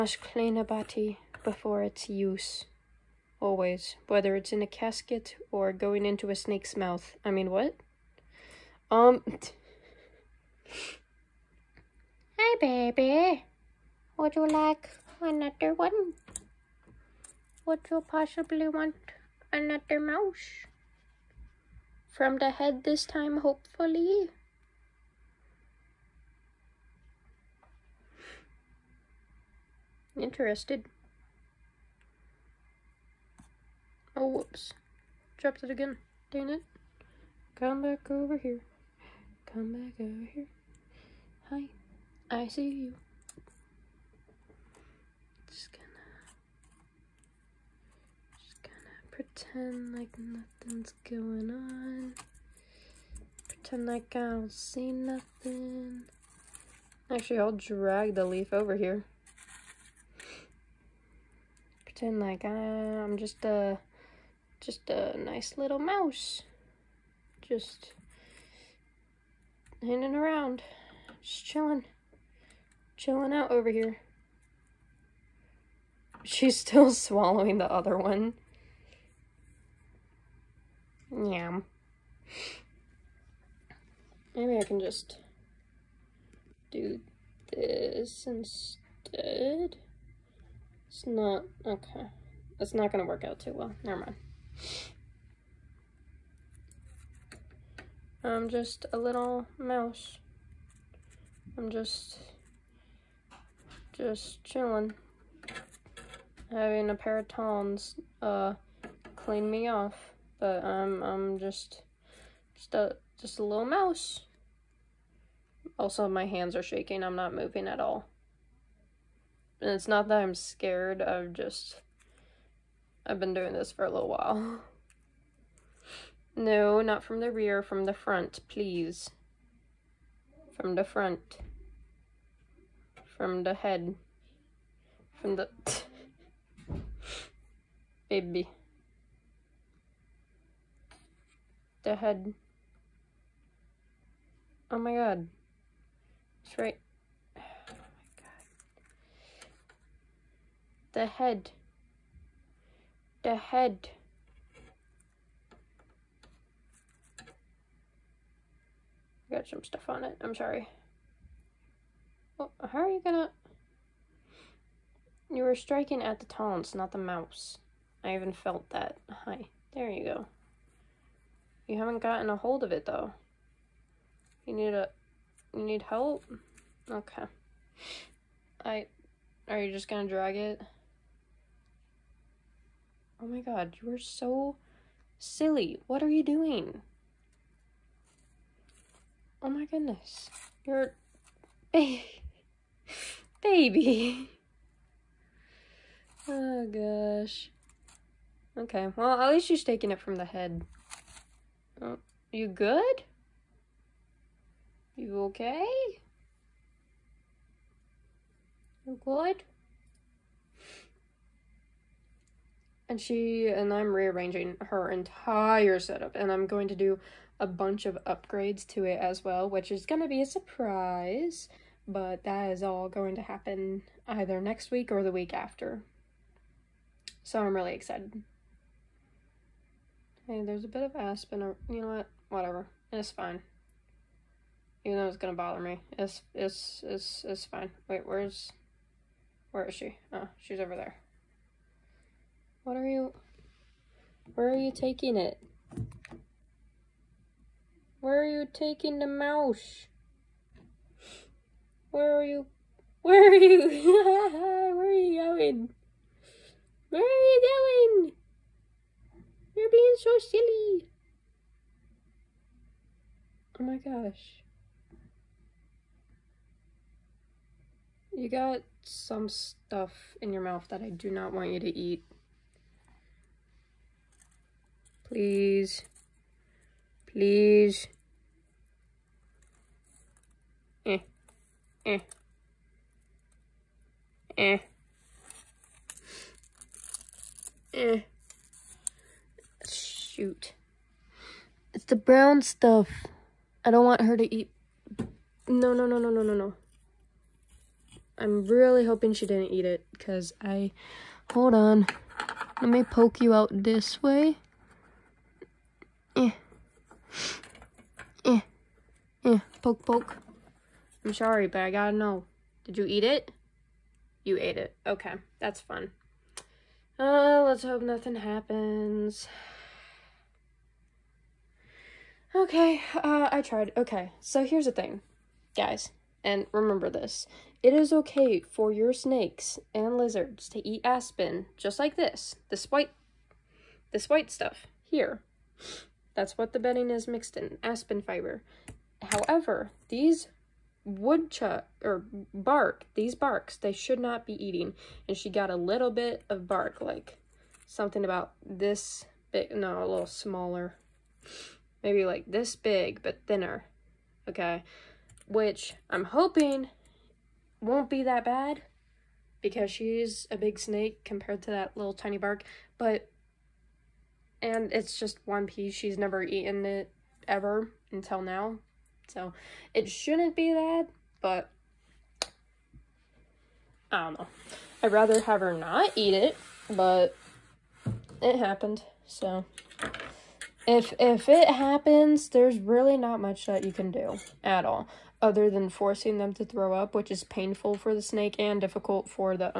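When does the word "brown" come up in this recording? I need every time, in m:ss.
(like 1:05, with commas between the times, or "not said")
4:51.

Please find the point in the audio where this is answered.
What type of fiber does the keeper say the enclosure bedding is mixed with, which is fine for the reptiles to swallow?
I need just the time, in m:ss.
5:37.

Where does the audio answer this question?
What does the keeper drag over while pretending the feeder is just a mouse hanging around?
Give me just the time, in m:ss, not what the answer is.
0:58.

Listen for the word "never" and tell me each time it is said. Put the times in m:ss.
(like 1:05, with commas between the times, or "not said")
1:33, 6:05.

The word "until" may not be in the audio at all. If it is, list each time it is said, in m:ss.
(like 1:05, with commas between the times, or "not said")
6:07.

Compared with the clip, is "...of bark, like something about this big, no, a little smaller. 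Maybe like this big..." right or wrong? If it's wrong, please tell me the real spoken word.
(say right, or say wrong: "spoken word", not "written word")
right.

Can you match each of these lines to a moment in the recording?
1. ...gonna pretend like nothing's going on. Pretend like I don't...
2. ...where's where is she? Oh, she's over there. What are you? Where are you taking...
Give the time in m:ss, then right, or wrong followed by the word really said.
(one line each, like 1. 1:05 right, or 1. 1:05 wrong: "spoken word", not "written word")
1. 0:48 right
2. 3:58 right.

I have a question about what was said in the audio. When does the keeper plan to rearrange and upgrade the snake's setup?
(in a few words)
next week or the week after.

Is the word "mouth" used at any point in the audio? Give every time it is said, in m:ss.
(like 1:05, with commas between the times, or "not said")
0:06, 4:30.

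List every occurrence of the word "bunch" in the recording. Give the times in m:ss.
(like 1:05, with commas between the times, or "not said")
3:37.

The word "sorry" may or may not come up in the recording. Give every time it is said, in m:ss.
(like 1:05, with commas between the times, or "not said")
2:40, 5:11.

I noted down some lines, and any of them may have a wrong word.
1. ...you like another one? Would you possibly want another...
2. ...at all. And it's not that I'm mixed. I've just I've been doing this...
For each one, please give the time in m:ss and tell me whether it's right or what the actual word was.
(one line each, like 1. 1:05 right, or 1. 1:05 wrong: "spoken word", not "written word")
1. 0:14 right
2. 1:57 wrong: "scared", not "mixed".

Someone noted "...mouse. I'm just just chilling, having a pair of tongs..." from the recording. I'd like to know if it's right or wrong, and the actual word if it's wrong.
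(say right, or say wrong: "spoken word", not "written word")
right.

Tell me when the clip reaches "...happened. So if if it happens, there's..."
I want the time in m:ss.
6:18.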